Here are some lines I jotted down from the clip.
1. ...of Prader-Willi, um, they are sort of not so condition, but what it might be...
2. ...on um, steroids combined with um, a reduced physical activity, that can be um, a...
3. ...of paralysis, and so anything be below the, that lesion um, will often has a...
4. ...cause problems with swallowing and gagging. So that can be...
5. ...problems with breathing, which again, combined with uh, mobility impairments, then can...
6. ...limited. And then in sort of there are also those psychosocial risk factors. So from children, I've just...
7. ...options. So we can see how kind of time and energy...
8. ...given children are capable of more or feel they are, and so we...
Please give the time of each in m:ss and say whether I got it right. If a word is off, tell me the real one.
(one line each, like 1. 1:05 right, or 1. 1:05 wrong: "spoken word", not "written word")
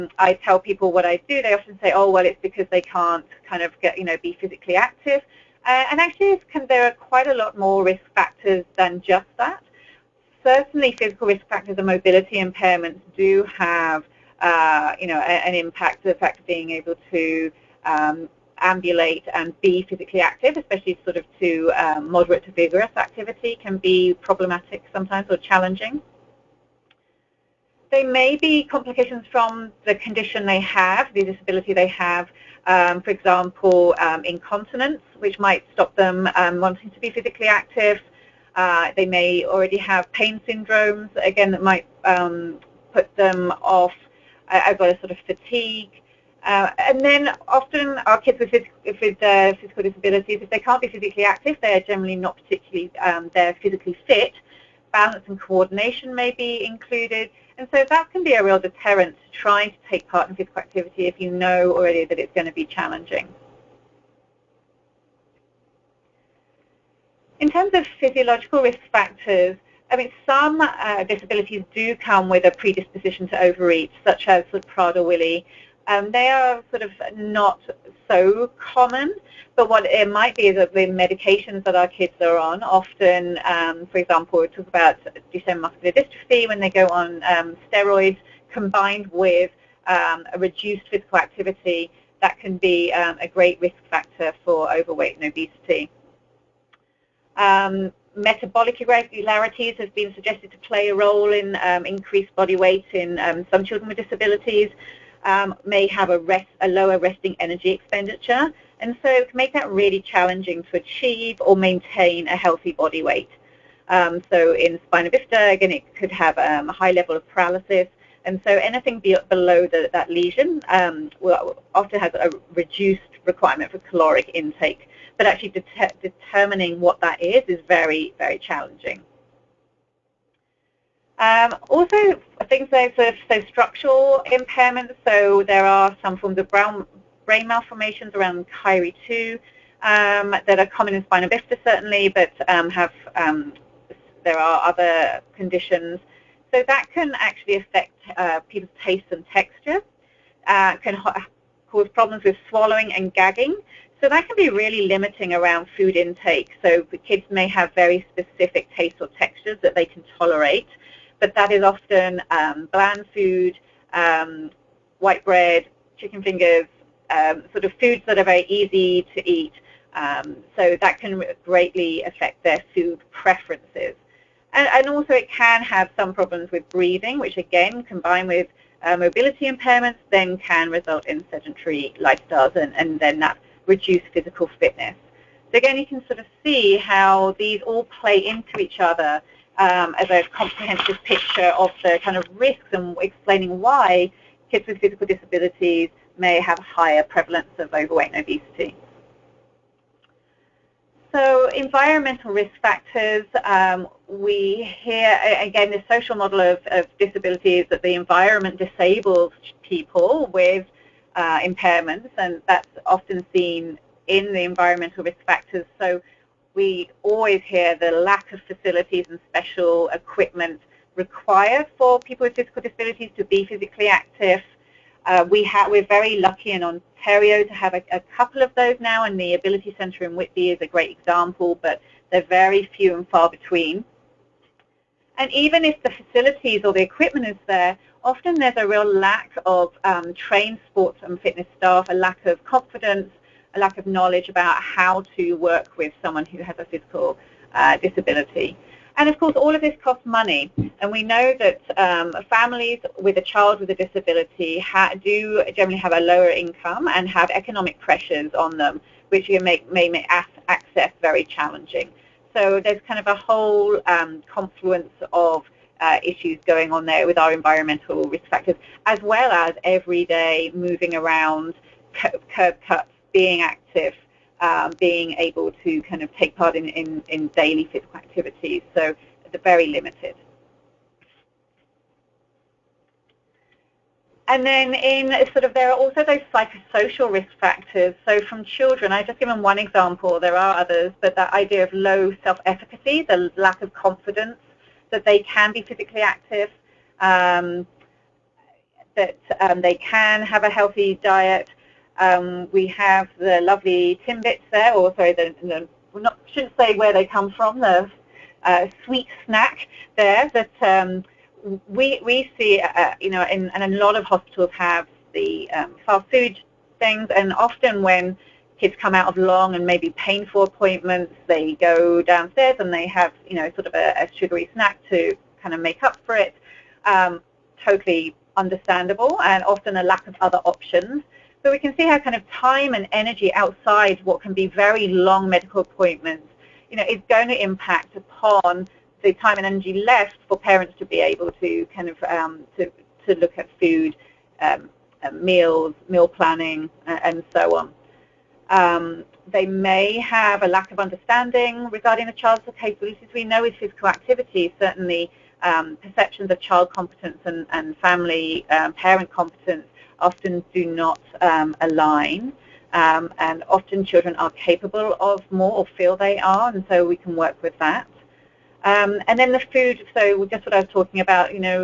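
1. 1:14 wrong: "common", not "condition"
2. 1:26 right
3. 1:57 right
4. 2:31 right
5. 2:56 right
6. 4:39 right
7. 5:30 right
8. 6:03 wrong: "often", not "given".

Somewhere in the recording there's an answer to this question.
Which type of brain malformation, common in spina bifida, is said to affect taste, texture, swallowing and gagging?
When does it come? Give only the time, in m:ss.
2:18.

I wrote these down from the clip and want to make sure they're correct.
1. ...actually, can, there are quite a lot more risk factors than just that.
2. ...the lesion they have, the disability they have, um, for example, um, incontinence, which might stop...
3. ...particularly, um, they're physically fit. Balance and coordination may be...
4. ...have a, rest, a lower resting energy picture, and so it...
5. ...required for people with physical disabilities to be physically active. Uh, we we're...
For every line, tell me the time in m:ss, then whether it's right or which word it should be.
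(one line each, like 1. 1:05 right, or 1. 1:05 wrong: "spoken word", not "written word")
1. 0:06 right
2. 0:29 wrong: "condition", not "lesion"
3. 0:52 right
4. 1:45 wrong: "expenditure", not "picture"
5. 3:40 right.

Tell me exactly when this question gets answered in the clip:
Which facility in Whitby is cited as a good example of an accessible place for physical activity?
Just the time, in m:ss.
3:49.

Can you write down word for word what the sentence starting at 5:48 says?
Um, they may have a lack of understanding regarding the child's capabilities.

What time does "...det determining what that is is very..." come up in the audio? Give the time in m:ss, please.
2:05.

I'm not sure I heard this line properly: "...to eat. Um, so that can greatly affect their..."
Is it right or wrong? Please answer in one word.
right.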